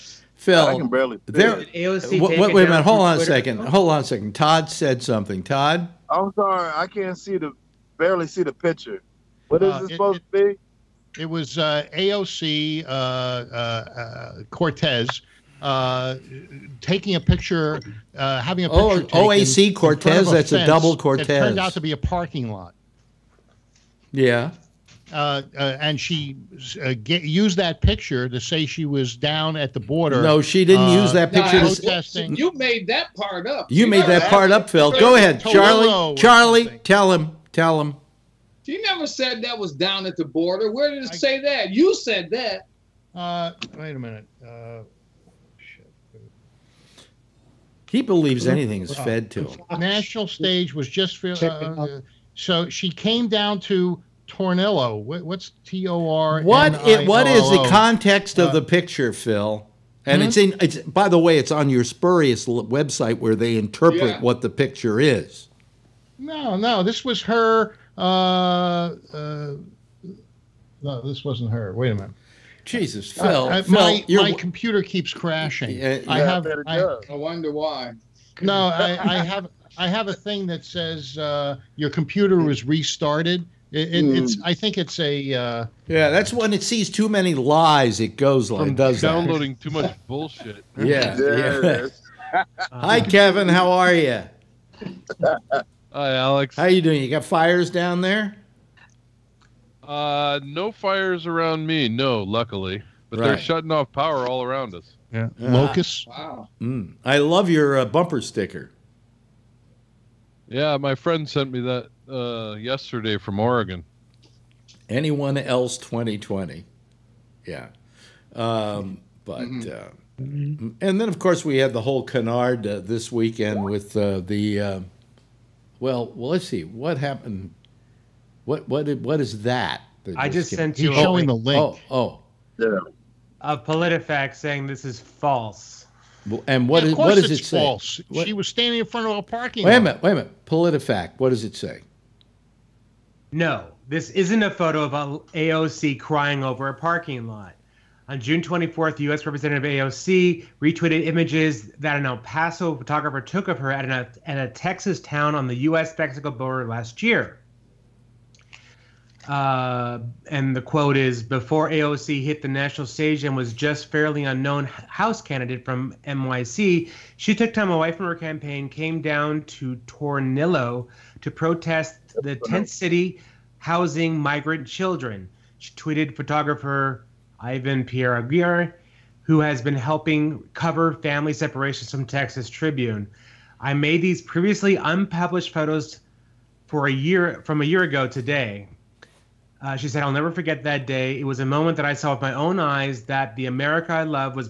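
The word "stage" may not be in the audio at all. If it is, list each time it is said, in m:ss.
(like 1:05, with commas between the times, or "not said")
0:50, 2:42.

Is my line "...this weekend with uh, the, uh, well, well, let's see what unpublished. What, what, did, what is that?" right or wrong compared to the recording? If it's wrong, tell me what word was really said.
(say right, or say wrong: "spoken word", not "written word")
wrong: "happened", not "unpublished".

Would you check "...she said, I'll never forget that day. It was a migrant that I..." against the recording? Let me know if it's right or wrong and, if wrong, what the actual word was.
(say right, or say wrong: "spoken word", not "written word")
wrong: "moment", not "migrant".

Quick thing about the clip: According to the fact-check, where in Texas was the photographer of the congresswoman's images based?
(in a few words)
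El Paso.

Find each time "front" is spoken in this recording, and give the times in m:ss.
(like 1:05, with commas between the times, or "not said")
2:18.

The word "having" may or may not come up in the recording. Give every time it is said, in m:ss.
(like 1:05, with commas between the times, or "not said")
0:18.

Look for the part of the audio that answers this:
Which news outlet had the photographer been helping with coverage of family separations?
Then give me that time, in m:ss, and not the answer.
3:02.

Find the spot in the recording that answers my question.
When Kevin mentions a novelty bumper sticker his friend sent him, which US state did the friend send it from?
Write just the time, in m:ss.
1:53.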